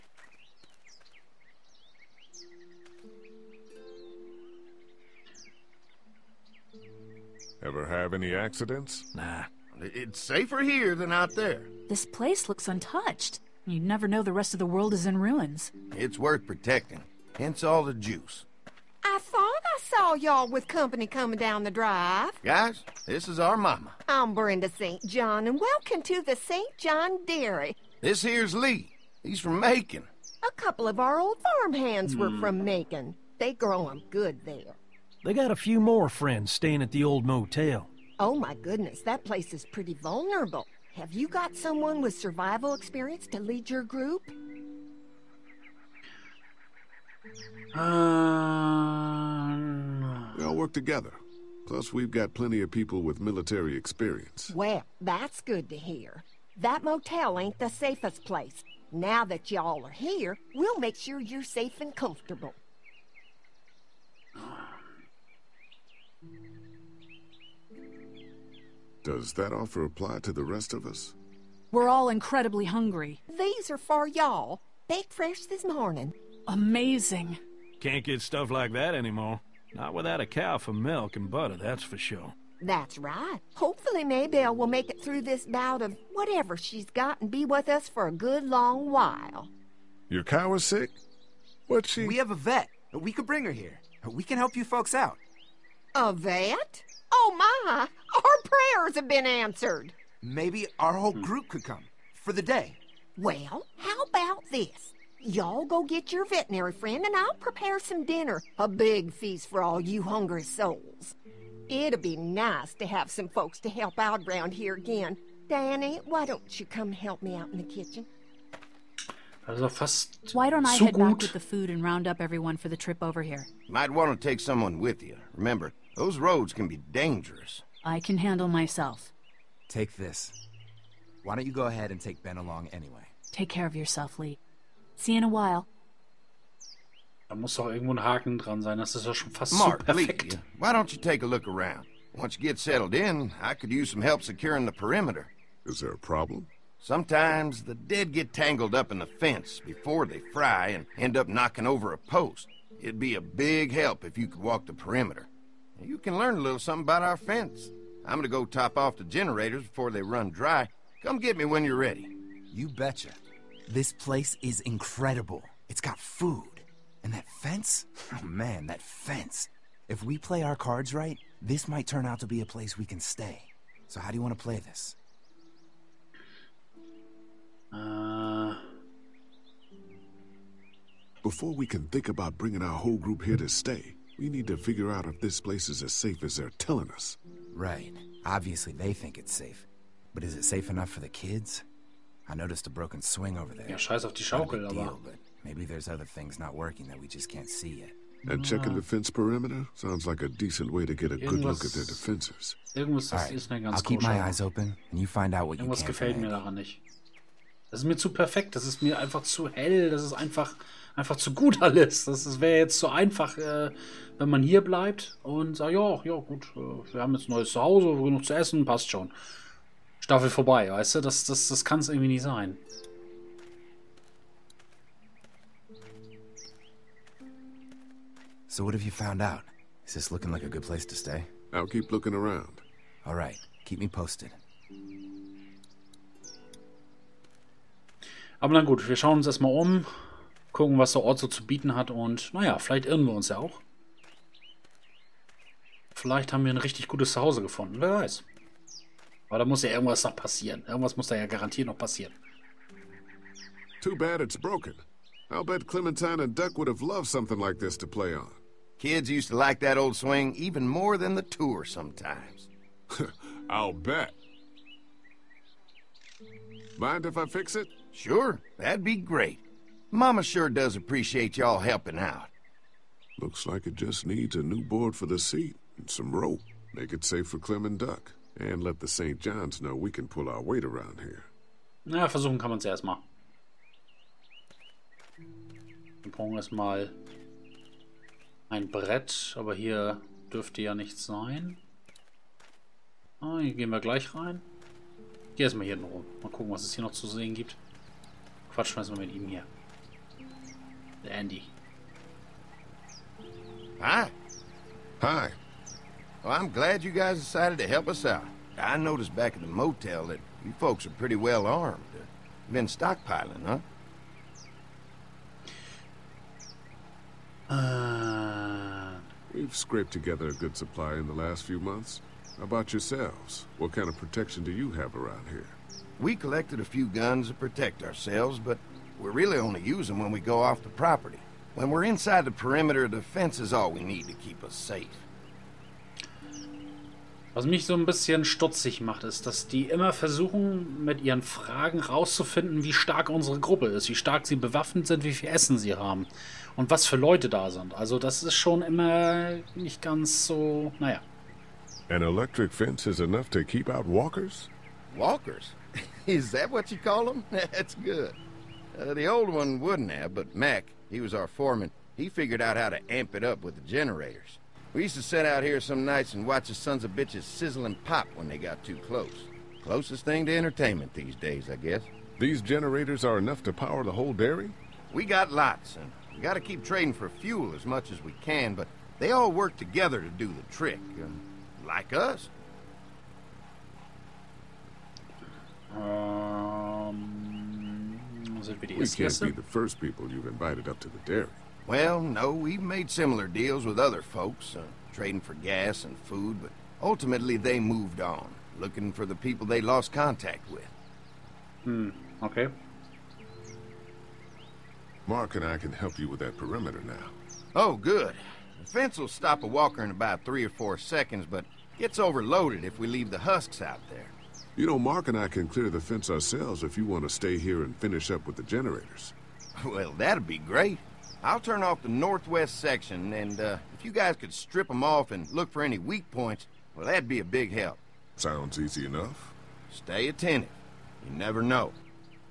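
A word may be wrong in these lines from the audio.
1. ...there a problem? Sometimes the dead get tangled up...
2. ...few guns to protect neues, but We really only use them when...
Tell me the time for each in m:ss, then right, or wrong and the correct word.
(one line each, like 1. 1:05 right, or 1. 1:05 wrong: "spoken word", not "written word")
1. 2:25 right
2. 5:26 wrong: "ourselves", not "neues".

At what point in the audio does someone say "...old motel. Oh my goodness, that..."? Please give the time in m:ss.
0:37.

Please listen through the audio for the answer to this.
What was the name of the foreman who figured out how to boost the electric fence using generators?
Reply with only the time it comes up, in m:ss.
6:00.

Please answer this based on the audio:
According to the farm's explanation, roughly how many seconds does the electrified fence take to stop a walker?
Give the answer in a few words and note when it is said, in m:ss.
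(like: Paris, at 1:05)
3 or 4 seconds, at 6:50.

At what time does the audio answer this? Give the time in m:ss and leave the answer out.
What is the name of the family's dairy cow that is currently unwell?
1:24.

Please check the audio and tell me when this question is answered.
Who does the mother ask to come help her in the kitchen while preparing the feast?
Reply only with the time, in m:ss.
1:55.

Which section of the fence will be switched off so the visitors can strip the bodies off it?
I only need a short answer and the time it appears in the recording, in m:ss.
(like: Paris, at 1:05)
northwest section, at 7:01.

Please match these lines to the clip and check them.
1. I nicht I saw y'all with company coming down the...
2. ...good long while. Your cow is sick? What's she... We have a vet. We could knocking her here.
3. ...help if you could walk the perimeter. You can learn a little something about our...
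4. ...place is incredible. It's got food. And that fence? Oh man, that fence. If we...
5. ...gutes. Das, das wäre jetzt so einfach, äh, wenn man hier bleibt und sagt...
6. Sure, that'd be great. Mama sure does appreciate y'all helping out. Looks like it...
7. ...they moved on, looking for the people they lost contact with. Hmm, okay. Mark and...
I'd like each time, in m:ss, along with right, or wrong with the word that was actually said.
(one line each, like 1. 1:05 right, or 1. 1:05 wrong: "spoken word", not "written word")
1. 0:19 wrong: "thought", not "nicht"
2. 1:28 wrong: "bring", not "knocking"
3. 2:33 right
4. 2:43 right
5. 3:31 wrong: "alles", not "gutes"
6. 4:27 right
7. 6:37 right.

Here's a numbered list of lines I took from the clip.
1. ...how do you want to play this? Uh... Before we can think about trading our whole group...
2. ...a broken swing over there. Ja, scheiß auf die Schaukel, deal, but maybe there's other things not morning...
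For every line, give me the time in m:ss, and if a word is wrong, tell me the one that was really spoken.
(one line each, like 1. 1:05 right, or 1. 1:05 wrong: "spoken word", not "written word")
1. 2:53 wrong: "bringing", not "trading"
2. 3:12 wrong: "working", not "morning".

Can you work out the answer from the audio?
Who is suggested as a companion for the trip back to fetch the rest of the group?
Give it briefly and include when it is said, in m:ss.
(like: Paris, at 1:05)
Ben, at 2:12.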